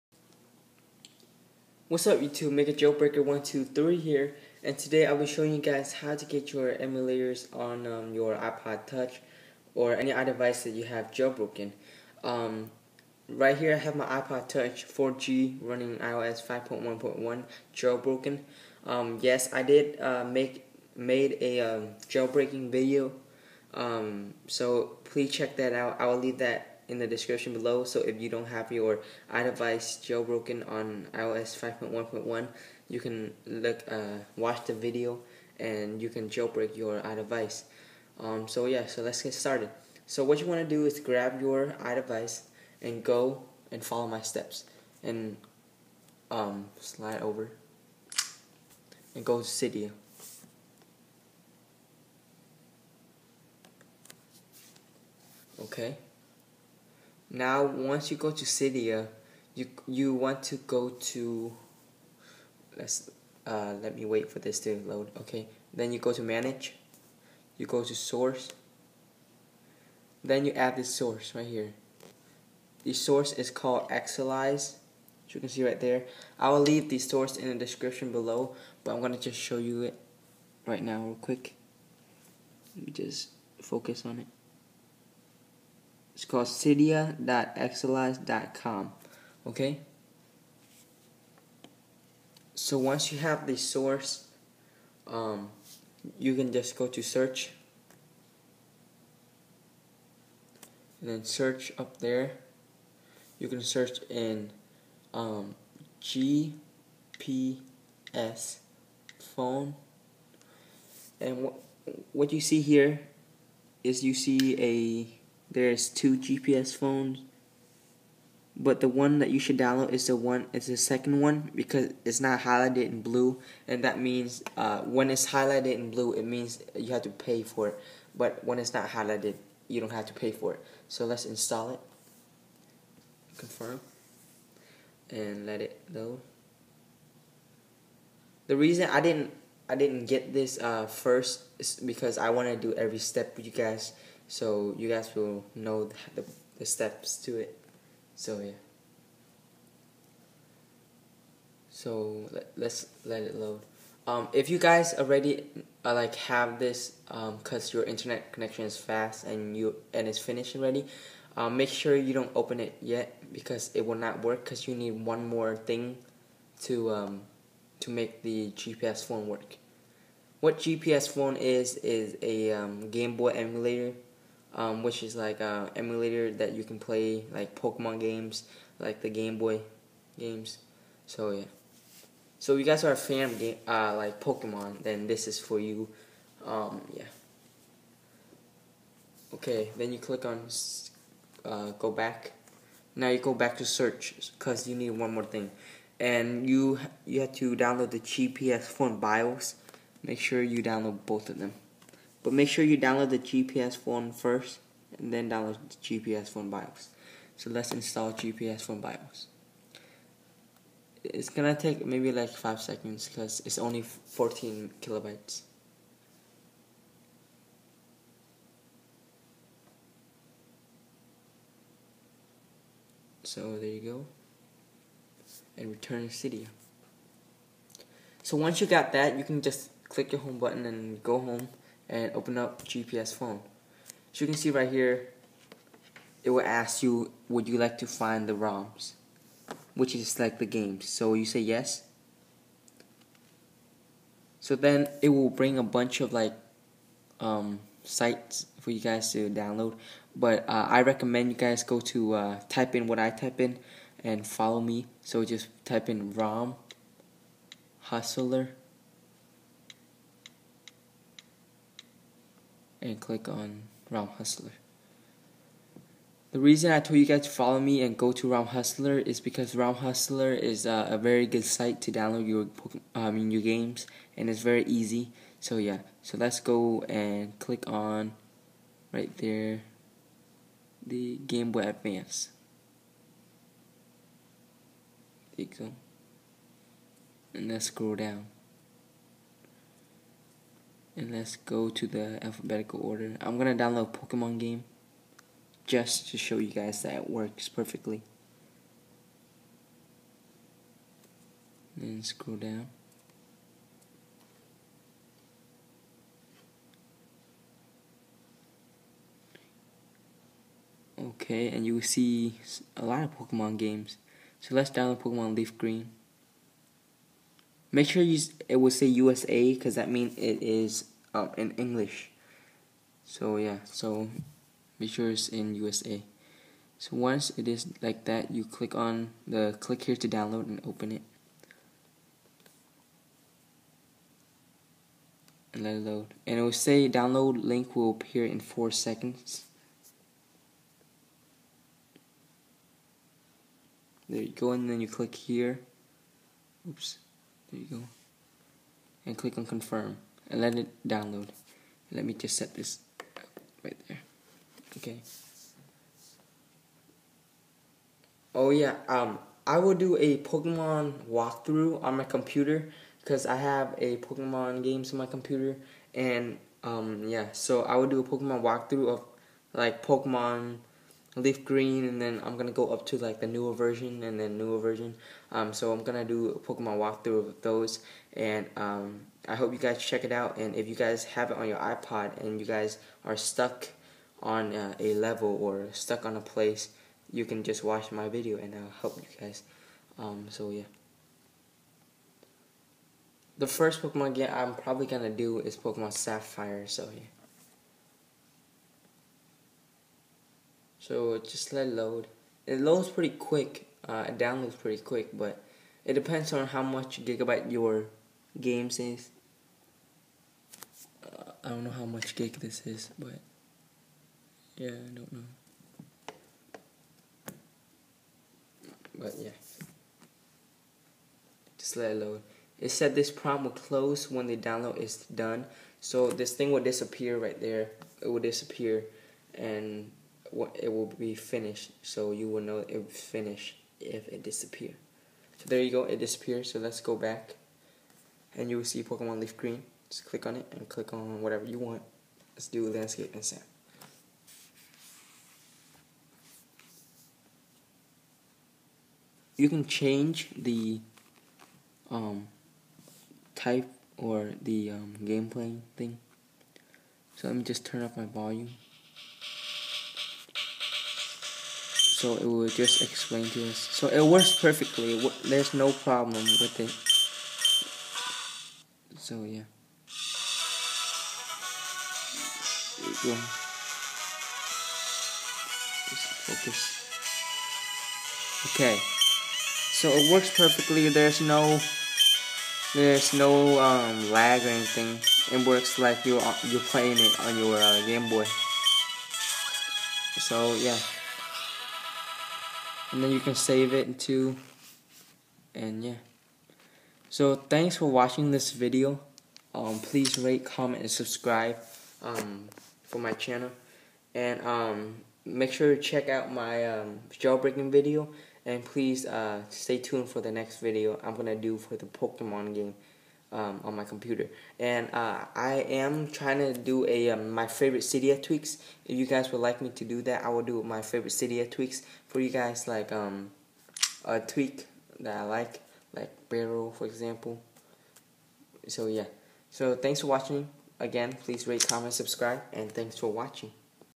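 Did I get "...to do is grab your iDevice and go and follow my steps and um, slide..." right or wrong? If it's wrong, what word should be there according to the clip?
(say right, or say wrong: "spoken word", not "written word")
right.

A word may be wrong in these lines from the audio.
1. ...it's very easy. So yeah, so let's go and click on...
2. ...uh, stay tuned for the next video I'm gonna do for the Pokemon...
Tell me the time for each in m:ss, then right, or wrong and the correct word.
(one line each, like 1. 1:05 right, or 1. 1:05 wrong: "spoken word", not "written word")
1. 4:34 right
2. 8:29 right.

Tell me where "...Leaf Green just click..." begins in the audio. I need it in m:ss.
7:19.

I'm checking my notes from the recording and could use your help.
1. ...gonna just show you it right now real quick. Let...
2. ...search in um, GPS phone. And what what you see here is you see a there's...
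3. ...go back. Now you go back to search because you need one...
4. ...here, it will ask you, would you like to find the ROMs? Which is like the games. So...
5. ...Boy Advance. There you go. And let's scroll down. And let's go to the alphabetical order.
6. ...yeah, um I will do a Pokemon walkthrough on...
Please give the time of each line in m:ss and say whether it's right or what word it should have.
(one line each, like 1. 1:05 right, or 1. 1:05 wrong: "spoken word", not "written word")
1. 1:19 right
2. 1:43 right
3. 3:11 right
4. 3:54 right
5. 4:41 right
6. 5:58 right.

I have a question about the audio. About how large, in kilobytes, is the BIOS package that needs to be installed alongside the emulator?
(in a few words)
14 kilobytes.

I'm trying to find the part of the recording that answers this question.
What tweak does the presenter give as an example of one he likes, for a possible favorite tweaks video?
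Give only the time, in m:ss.
8:46.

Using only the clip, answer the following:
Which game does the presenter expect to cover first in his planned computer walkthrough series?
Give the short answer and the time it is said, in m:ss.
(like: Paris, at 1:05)
Pokemon Sapphire, at 6:35.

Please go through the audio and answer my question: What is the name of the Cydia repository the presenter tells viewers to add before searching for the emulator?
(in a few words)
Xsellize.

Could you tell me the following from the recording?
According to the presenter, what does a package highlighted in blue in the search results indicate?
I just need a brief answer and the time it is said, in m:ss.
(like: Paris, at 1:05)
You have to pay, at 2:06.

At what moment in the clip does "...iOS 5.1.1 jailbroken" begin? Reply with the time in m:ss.
0:15.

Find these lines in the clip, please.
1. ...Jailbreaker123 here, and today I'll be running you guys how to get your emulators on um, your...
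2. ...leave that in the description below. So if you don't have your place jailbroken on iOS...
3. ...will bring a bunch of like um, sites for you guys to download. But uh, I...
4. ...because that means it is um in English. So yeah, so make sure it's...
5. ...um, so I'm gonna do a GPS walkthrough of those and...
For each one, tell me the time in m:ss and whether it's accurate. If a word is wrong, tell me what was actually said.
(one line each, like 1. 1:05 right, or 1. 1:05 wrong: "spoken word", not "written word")
1. 0:02 wrong: "showing", not "running"
2. 0:26 wrong: "iDevice", not "place"
3. 4:05 right
4. 5:19 right
5. 6:15 wrong: "Pokemon", not "GPS".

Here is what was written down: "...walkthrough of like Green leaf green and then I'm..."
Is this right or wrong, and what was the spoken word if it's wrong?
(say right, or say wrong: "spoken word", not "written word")
wrong: "Pokemon", not "Green".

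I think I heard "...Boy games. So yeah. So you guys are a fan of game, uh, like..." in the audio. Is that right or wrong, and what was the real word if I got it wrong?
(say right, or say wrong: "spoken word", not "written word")
right.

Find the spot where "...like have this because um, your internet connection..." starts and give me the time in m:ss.
2:35.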